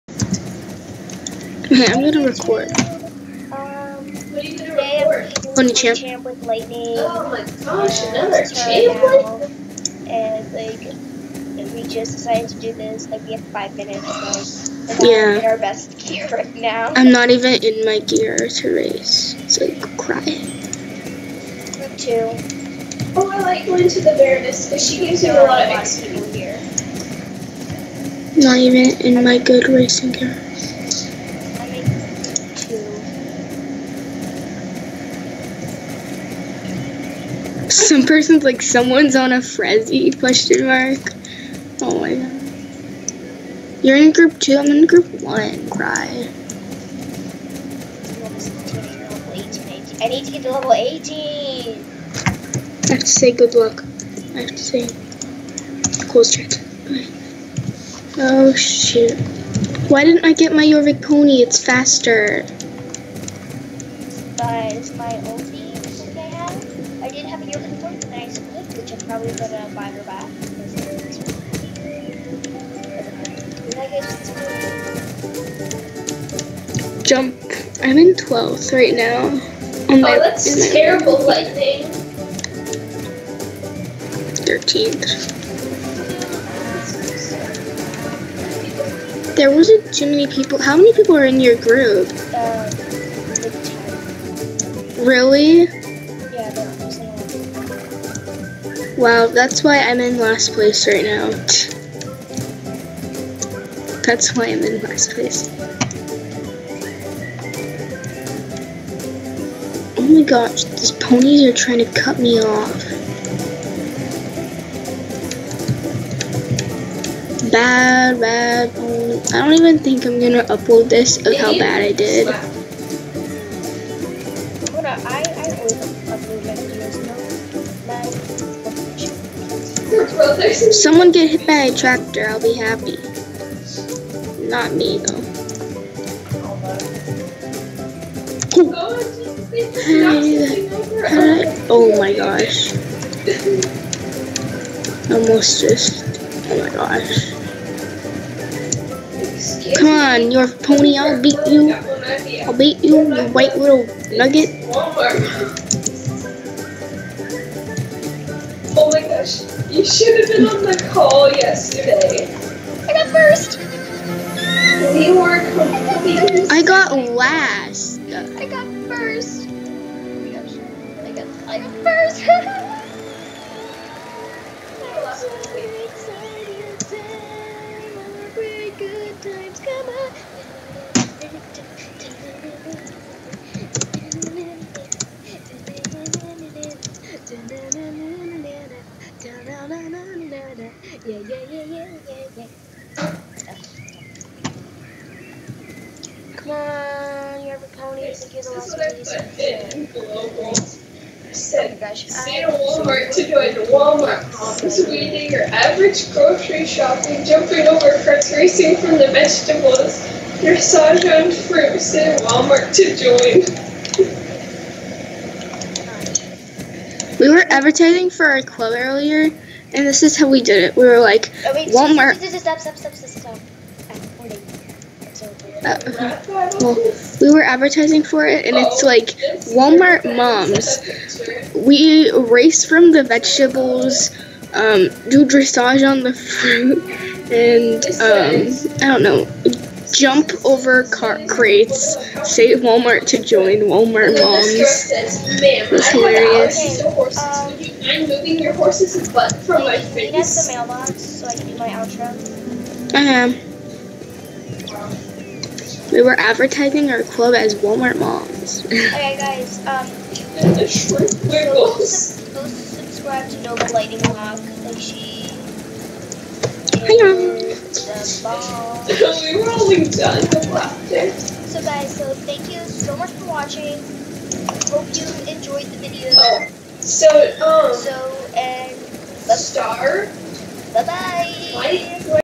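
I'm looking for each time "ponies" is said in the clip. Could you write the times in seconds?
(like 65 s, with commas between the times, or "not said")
110 s, 197 s.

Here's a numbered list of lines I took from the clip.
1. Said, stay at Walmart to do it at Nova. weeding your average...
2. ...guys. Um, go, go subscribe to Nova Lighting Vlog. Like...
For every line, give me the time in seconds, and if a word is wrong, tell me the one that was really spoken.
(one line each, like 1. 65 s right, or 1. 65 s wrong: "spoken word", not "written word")
1. 201 s wrong: "Walmart", not "Nova"
2. 259 s right.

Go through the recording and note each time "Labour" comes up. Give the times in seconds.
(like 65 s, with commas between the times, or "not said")
not said.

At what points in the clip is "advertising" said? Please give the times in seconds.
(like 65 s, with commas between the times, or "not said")
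217 s, 227 s, 256 s.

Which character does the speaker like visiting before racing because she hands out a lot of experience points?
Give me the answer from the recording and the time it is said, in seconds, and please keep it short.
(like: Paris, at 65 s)
The Baroness, at 24 s.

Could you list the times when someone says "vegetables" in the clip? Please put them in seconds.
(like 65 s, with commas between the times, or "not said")
209 s, 233 s.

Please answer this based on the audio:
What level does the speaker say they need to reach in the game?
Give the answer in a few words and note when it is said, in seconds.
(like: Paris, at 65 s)
18, at 50 s.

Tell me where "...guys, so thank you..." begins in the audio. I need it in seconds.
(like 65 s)
271 s.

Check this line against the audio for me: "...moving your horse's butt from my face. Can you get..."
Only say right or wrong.
right.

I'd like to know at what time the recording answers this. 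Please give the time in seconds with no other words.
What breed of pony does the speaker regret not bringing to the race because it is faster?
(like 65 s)
60 s.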